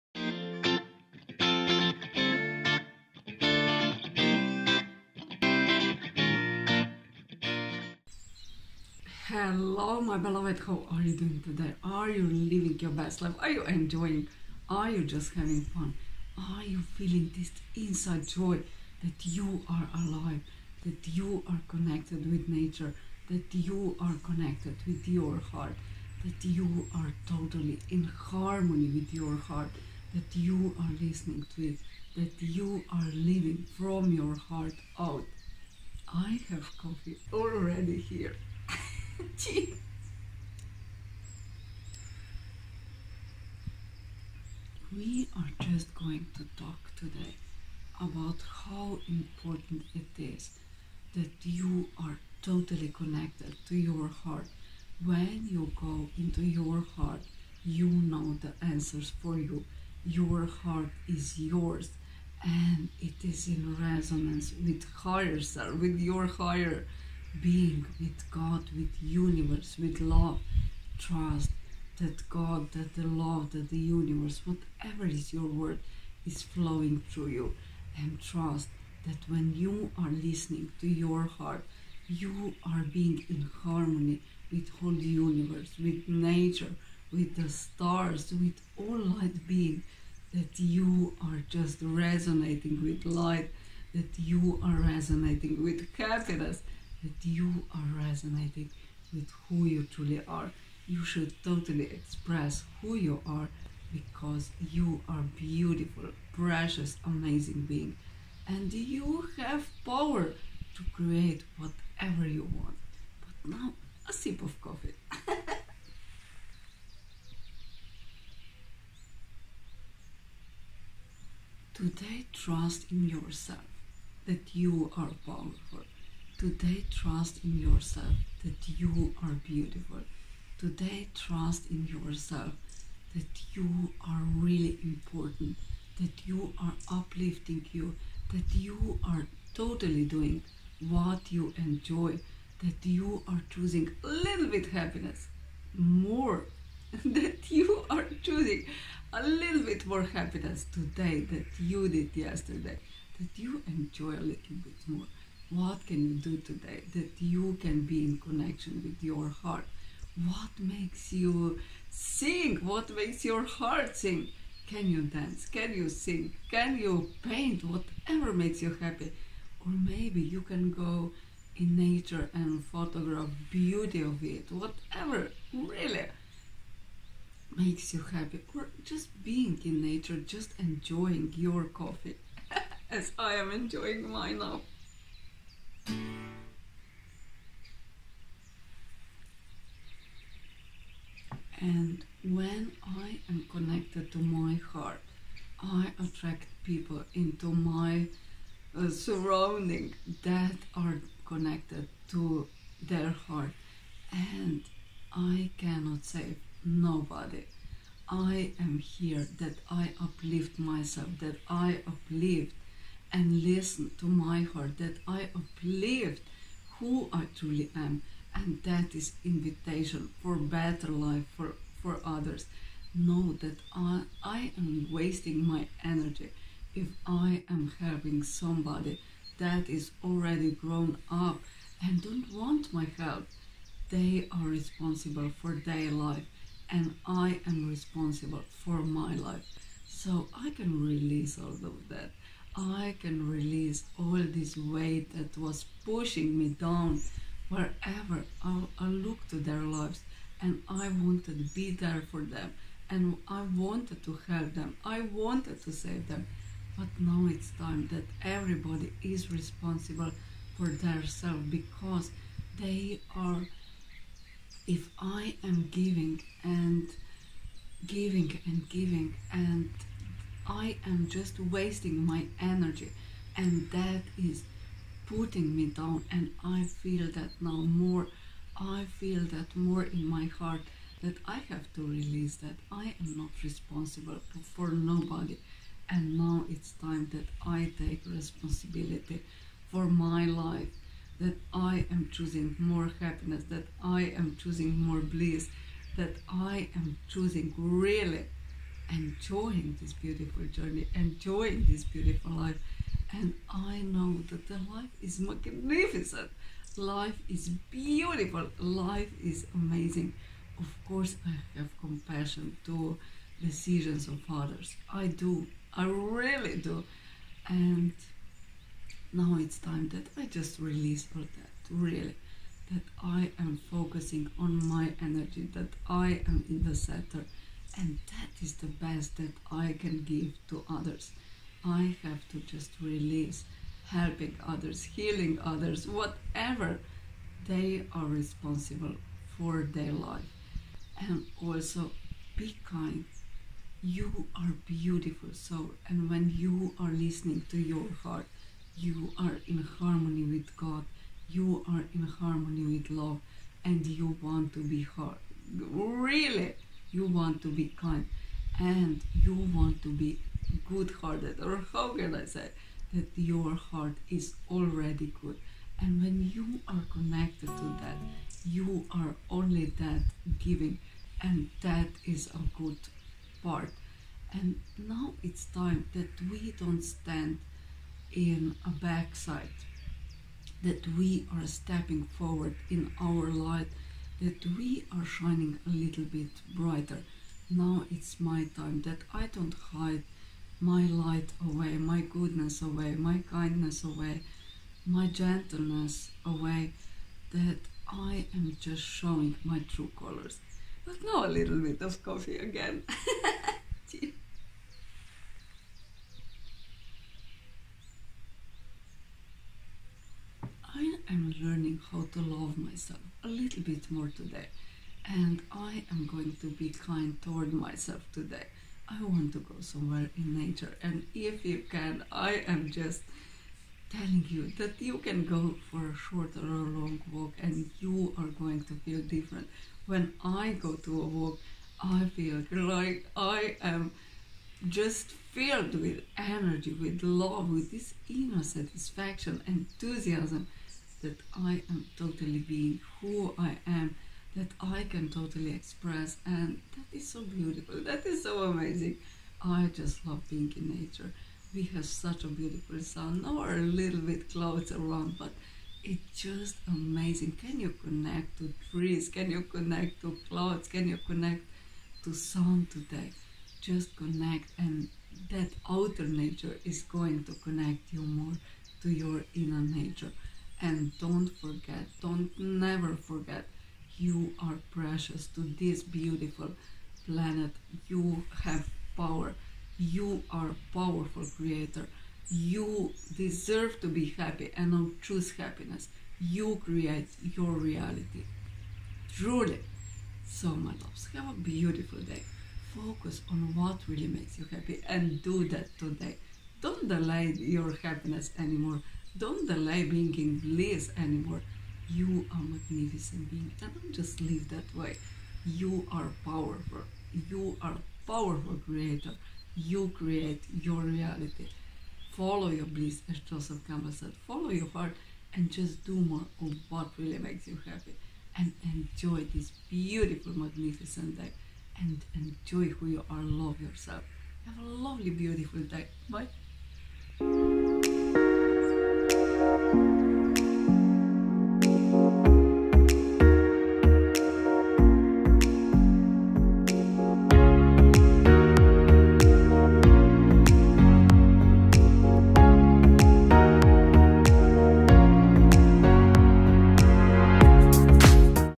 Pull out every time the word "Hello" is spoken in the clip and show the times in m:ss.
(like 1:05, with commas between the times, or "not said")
0:09.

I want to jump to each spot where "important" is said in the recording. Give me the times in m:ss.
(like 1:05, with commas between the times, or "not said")
0:49, 2:14.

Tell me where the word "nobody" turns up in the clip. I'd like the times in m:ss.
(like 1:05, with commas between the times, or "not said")
3:26, 4:44.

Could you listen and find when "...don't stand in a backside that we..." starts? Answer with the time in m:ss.
6:16.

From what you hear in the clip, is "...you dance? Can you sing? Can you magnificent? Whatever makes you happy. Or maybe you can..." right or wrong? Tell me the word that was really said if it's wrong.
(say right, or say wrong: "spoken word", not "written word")
wrong: "paint", not "magnificent".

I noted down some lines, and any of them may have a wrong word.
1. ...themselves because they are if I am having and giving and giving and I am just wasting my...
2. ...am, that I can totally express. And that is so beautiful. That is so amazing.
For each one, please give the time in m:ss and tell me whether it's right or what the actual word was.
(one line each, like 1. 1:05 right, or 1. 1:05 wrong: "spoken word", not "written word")
1. 4:20 wrong: "giving", not "having"
2. 7:23 right.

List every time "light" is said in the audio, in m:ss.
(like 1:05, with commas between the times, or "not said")
1:28, 1:33, 6:23, 6:30.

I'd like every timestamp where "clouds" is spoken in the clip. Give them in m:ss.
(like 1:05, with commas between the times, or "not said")
7:34, 7:40.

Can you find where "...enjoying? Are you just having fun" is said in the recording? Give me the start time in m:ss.
0:13.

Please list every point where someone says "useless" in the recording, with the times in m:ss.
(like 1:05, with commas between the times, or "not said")
not said.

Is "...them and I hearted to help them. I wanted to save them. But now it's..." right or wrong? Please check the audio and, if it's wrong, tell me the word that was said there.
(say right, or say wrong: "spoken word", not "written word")
wrong: "wanted", not "hearted".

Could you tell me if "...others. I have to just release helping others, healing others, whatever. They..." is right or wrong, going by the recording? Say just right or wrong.
right.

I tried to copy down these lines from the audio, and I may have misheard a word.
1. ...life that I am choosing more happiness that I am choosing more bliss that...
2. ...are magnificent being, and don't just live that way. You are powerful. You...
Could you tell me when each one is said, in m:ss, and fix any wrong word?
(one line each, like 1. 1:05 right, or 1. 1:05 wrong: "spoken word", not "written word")
1. 4:50 right
2. 8:22 right.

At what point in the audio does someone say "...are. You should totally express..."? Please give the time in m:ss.
1:40.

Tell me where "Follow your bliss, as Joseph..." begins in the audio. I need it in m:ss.
8:32.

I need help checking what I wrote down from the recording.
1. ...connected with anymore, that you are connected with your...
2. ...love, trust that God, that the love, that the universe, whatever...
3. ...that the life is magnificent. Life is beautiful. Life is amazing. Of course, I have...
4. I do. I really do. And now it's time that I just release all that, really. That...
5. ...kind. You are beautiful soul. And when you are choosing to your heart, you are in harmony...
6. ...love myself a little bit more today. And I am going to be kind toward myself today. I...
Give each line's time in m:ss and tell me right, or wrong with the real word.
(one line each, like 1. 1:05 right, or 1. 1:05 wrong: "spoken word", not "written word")
1. 0:21 wrong: "nature", not "anymore"
2. 1:10 right
3. 5:04 right
4. 5:14 right
5. 5:42 wrong: "listening", not "choosing"
6. 6:52 right.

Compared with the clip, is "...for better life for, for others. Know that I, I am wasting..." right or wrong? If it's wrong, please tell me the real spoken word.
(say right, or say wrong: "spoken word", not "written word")
right.